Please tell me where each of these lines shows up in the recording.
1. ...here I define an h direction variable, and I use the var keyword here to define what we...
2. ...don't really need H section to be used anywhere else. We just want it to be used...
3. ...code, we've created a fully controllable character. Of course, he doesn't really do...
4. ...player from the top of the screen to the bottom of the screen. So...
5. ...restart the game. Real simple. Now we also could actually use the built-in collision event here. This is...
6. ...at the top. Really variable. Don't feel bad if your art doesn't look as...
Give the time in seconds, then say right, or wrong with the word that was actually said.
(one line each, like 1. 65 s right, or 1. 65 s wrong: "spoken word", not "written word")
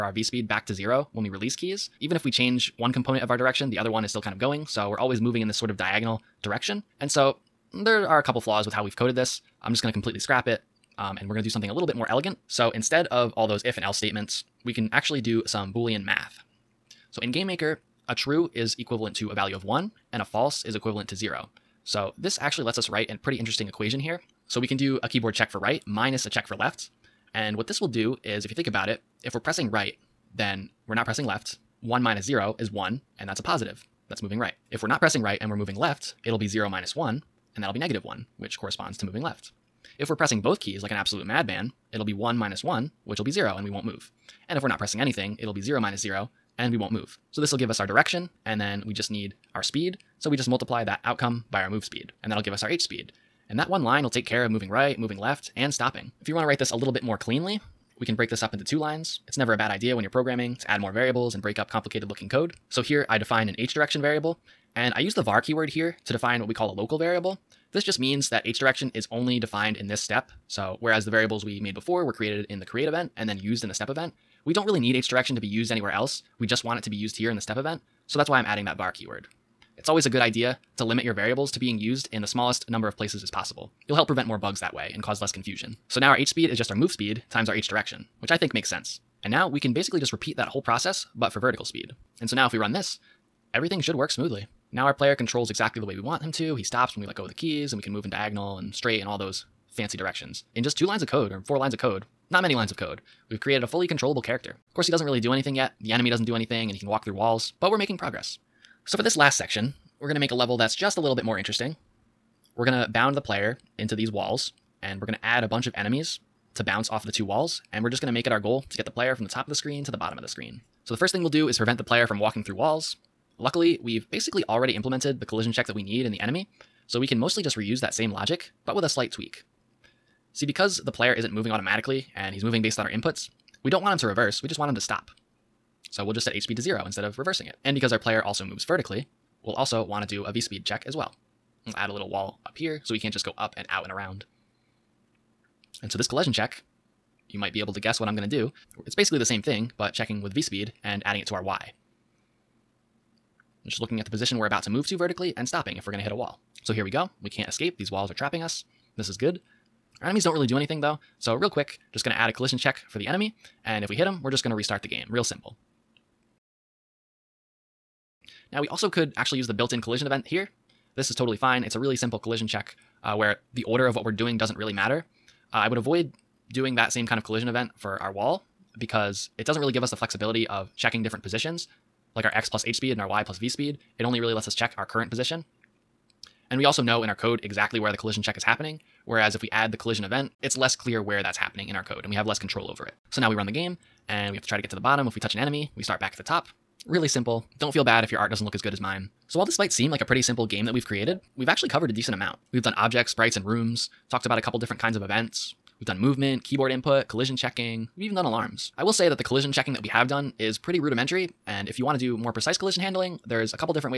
1. 62 s right
2. 74 s wrong: "direction", not "section"
3. 102 s right
4. 118 s right
5. 164 s right
6. 196 s wrong: "simple", not "variable".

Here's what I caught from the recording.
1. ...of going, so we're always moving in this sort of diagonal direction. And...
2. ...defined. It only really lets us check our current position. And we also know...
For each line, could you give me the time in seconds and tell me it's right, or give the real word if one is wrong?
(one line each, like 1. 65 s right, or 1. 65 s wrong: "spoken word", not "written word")
1. 4 s right
2. 183 s wrong: "speed", not "defined".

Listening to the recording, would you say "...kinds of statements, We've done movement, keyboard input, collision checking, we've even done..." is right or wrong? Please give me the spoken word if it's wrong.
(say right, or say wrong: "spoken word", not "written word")
wrong: "events", not "statements".